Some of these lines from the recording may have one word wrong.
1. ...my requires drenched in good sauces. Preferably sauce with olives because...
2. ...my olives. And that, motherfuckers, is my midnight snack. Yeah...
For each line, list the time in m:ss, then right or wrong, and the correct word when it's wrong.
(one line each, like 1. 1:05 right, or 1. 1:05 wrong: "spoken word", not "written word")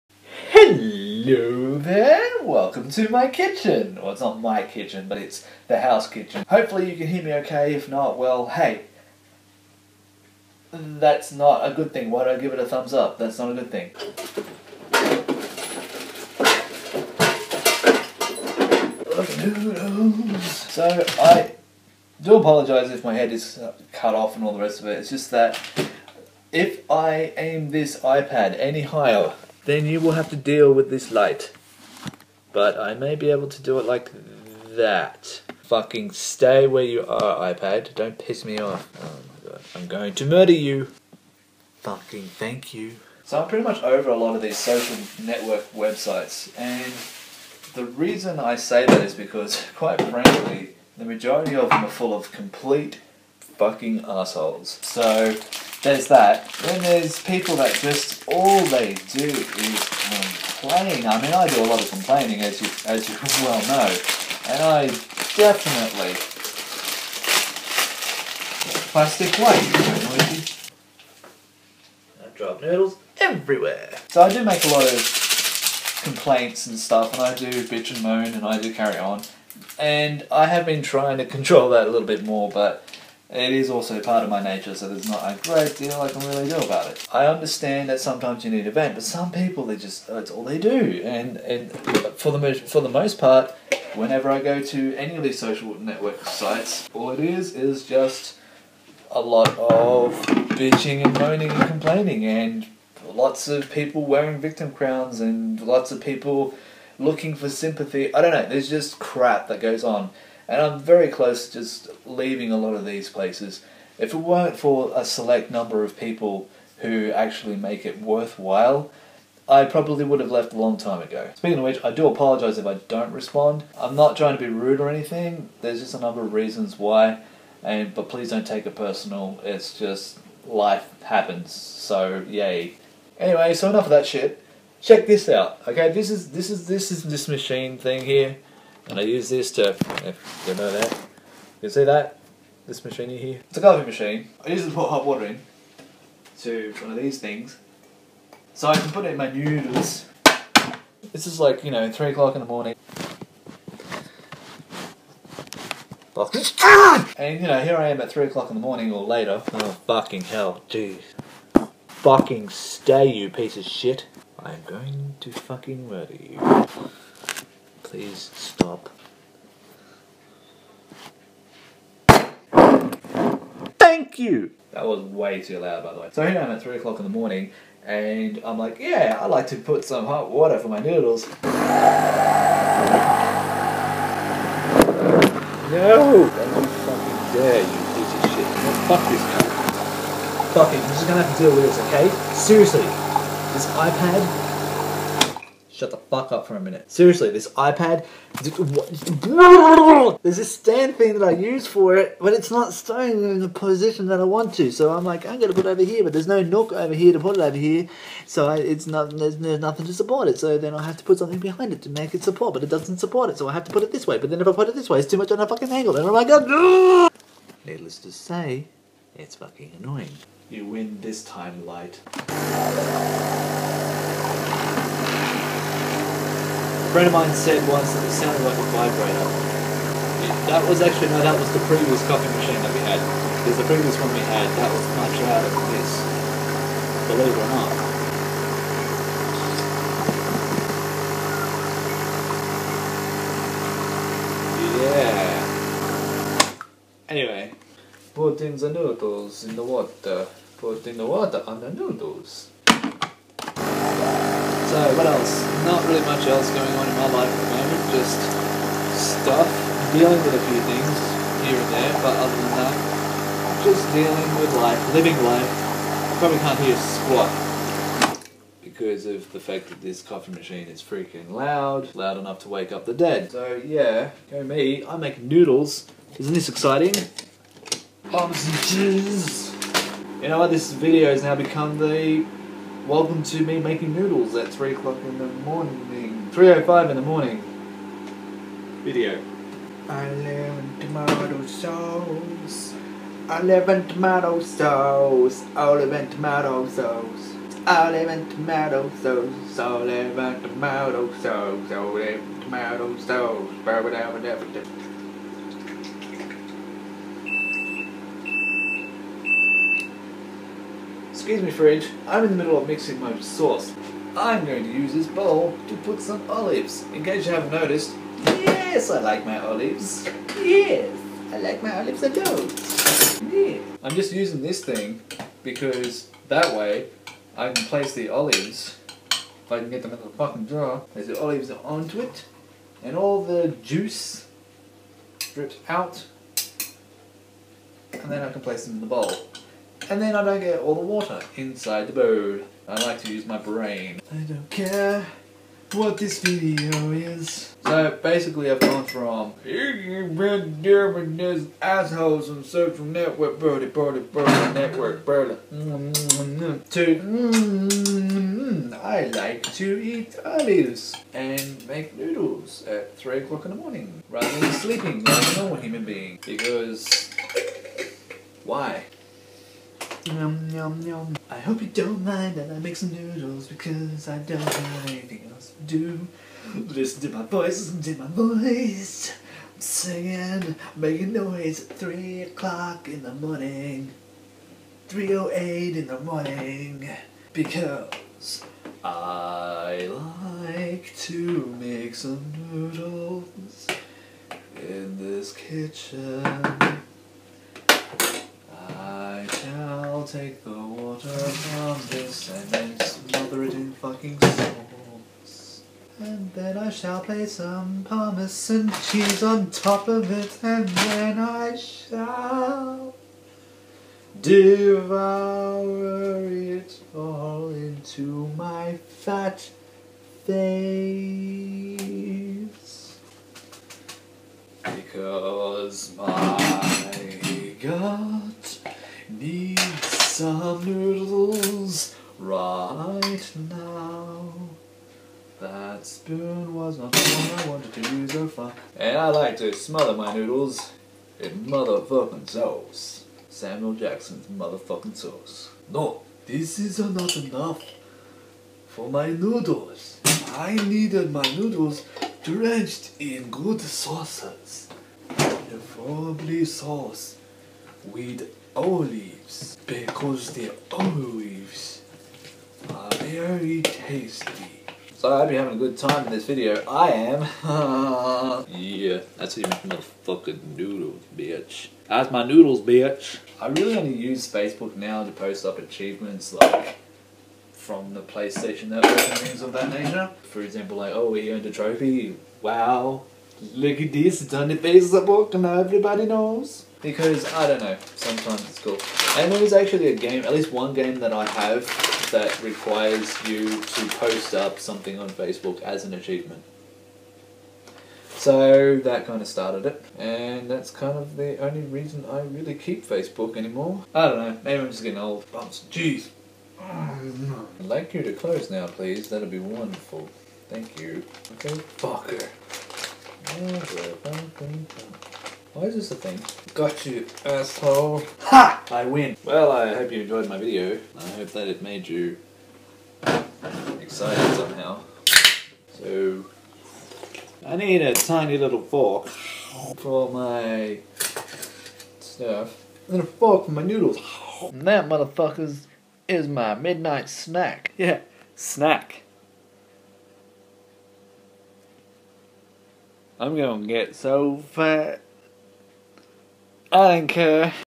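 1. 7:31 wrong: "noodles", not "requires"
2. 8:53 wrong: "noodles", not "olives".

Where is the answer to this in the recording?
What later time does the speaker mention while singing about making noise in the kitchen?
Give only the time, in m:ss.
6:24.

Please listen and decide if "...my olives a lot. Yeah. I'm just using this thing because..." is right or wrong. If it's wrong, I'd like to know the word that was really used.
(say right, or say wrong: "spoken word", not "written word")
right.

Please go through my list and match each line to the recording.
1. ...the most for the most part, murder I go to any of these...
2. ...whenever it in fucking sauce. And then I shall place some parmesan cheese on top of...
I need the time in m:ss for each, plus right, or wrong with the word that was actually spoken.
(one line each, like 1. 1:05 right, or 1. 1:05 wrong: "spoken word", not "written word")
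1. 1:32 wrong: "whenever", not "murder"
2. 6:42 wrong: "smother", not "whenever".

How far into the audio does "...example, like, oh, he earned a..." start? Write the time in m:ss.
8:00.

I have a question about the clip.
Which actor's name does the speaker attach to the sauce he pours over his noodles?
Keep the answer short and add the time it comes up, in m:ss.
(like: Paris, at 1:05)
Samuel Jackson, at 7:23.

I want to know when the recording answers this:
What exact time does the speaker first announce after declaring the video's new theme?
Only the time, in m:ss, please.
4:46.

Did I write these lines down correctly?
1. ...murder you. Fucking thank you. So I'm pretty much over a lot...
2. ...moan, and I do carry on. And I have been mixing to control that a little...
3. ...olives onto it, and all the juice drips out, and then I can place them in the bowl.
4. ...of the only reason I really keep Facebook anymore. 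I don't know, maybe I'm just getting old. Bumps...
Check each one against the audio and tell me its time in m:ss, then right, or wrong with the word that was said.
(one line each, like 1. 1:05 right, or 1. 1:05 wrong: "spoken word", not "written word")
1. 0:40 right
2. 1:18 wrong: "trying", not "mixing"
3. 5:31 right
4. 8:20 right.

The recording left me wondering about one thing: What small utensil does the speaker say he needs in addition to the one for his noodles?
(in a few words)
Tiny little fork.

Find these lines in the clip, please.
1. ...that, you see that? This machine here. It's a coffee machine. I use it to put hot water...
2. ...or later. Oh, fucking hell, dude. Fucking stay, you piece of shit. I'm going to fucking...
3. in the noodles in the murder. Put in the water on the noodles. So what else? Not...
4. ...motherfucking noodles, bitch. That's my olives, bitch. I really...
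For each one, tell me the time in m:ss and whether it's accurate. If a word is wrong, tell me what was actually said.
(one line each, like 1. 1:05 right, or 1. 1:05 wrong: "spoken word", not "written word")
1. 2:20 right
2. 2:38 right
3. 4:08 wrong: "water", not "murder"
4. 7:49 wrong: "noodles", not "olives".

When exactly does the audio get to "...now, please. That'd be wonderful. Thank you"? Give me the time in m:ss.
8:28.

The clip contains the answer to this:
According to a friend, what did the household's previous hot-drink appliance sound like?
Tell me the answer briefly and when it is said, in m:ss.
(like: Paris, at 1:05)
A vibrator, at 3:48.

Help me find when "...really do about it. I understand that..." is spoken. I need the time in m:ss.
1:26.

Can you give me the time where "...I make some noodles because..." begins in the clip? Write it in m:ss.
6:12.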